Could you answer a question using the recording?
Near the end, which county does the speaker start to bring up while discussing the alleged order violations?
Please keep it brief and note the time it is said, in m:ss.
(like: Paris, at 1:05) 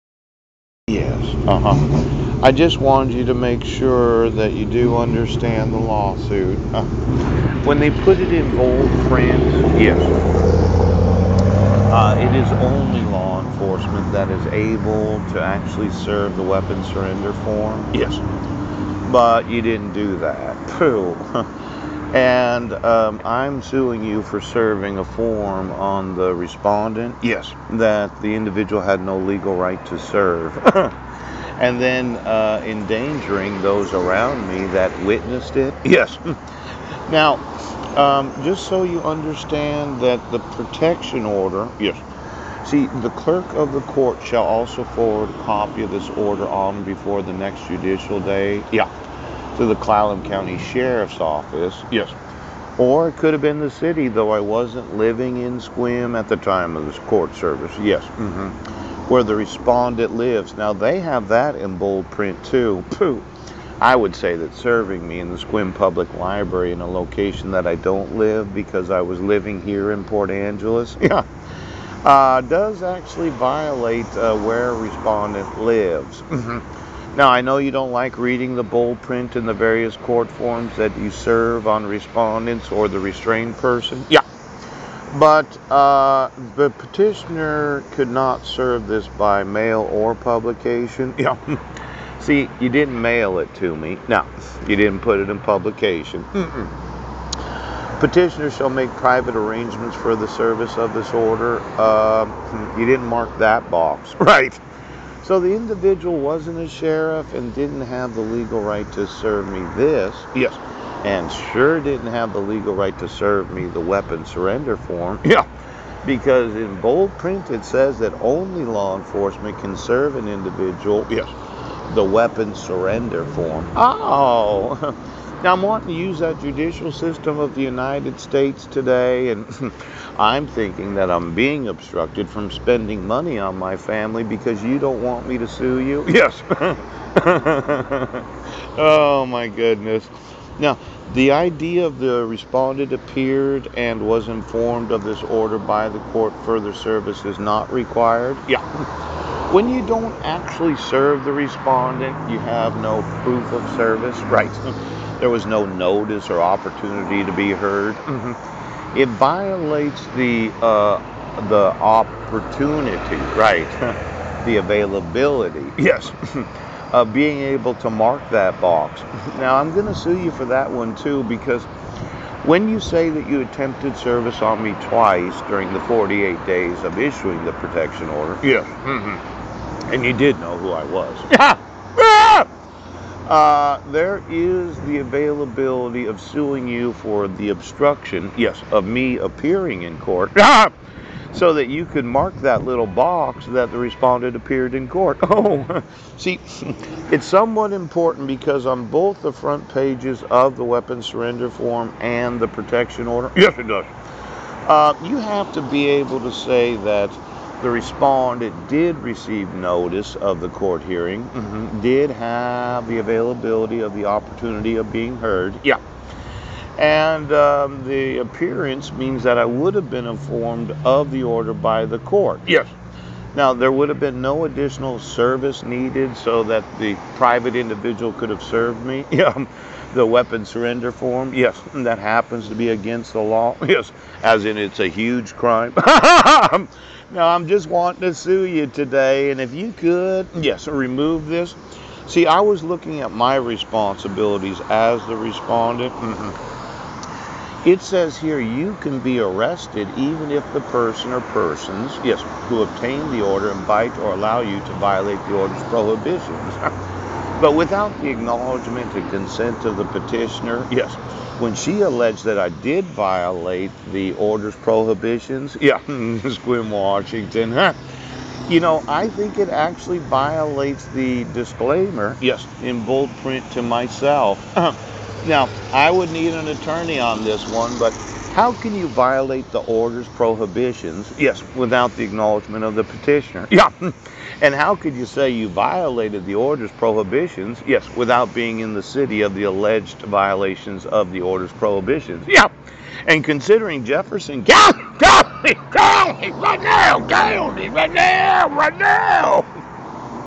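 Jefferson County, at 4:53.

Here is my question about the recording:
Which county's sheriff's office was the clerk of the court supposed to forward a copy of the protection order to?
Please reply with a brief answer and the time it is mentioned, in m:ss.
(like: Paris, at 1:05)
Clallam County, at 0:49.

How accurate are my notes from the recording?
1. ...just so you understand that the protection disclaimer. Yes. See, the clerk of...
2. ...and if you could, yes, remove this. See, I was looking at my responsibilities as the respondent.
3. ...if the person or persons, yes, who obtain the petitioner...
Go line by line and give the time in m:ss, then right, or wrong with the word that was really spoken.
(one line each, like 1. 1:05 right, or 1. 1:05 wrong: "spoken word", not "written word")
1. 0:38 wrong: "order", not "disclaimer"
2. 3:59 right
3. 4:10 wrong: "order", not "petitioner".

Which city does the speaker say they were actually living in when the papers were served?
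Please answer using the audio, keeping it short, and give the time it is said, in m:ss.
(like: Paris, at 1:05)
Port Angeles, at 1:10.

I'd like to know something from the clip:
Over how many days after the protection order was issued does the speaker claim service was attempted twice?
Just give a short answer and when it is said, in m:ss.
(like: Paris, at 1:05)
48, at 2:55.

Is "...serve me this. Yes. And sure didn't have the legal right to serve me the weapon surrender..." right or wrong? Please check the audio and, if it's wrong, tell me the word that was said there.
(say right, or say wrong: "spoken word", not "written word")
right.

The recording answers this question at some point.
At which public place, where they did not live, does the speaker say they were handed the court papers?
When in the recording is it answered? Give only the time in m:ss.
1:05.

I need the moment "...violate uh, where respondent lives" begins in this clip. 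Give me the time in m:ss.
1:13.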